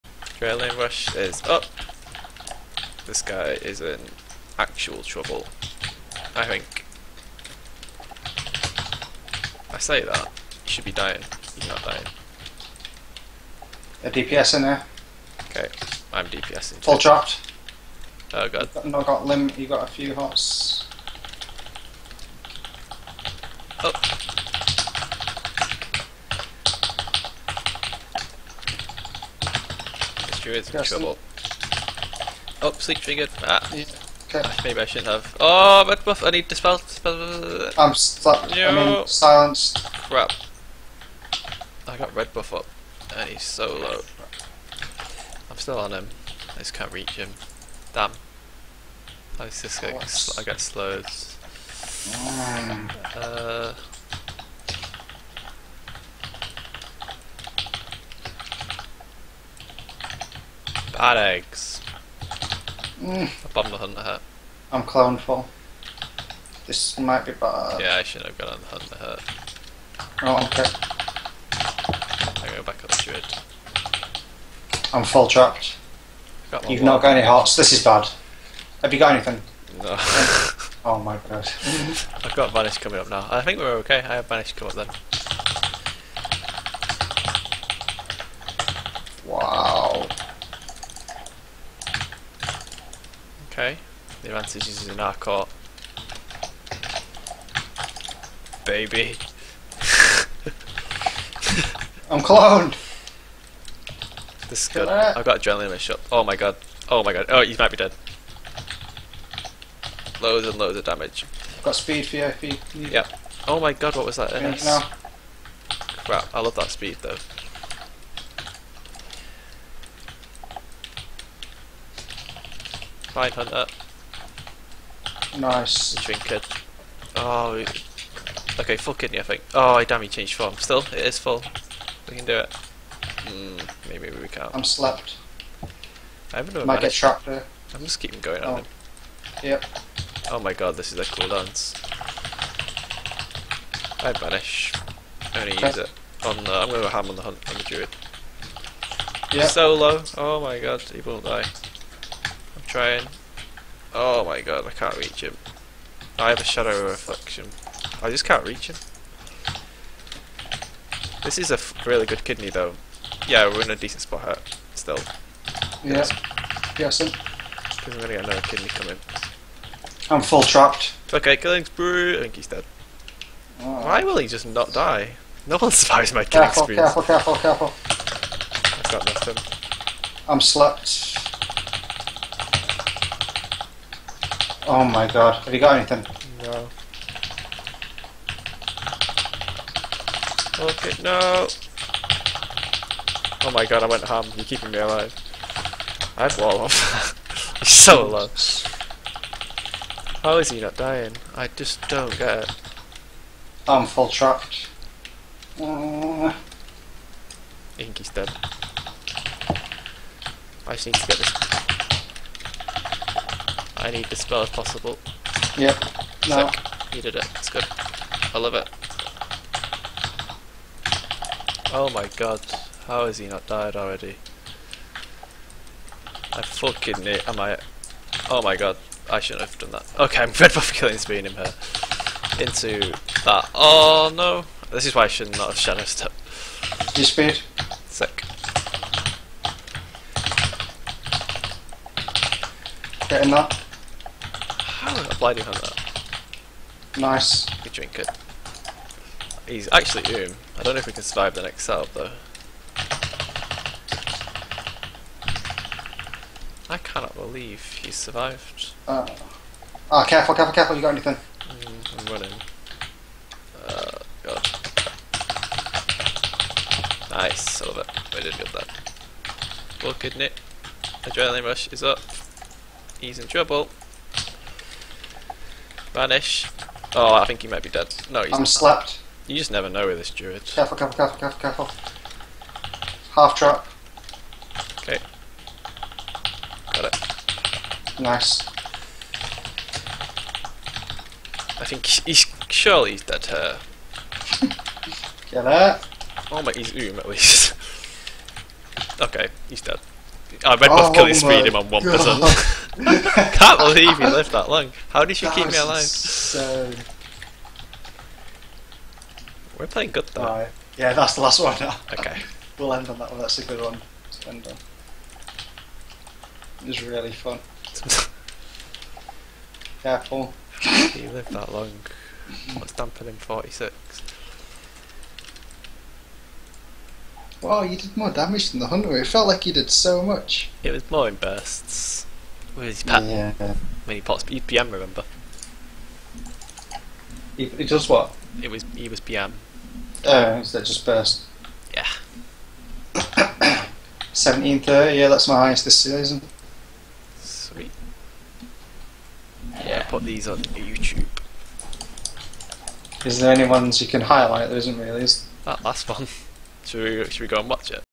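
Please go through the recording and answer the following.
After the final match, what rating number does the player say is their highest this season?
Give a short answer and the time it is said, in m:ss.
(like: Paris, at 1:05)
1730, at 5:44.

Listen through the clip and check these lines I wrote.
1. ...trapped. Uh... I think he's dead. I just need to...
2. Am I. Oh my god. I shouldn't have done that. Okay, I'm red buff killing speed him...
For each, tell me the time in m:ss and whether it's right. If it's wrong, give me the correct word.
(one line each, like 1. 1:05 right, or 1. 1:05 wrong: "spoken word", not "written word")
1. 3:24 right
2. 3:47 right.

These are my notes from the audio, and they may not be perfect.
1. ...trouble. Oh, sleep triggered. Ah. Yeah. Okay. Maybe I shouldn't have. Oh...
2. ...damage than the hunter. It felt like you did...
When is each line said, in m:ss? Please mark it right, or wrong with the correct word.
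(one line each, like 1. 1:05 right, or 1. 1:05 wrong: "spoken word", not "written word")
1. 0:30 right
2. 5:28 right.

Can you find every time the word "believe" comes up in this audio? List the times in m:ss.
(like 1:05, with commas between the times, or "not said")
4:17, 5:03.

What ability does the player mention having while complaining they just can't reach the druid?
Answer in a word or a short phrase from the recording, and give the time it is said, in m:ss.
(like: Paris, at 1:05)
Shadow Reflection, at 2:36.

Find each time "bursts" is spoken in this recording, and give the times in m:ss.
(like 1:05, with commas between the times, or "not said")
5:31, 5:40.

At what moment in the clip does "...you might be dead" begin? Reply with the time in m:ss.
1:47.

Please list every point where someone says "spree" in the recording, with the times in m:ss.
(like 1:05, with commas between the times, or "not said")
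2:51, 2:56.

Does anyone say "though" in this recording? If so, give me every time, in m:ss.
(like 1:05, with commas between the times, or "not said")
1:57, 2:42, 4:11, 5:10.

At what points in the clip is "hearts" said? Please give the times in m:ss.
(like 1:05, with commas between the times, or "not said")
1:17.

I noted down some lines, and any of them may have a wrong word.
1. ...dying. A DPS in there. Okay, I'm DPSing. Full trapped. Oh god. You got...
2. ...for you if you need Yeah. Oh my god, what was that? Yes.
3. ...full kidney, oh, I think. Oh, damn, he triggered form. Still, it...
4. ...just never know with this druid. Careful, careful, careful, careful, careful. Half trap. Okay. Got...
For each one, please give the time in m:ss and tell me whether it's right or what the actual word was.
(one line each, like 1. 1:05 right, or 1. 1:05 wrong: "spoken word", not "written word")
1. 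0:11 right
2. 1:52 right
3. 2:08 wrong: "changed", not "triggered"
4. 4:39 right.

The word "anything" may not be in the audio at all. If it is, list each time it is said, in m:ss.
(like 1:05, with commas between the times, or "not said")
1:19, 3:05, 4:20.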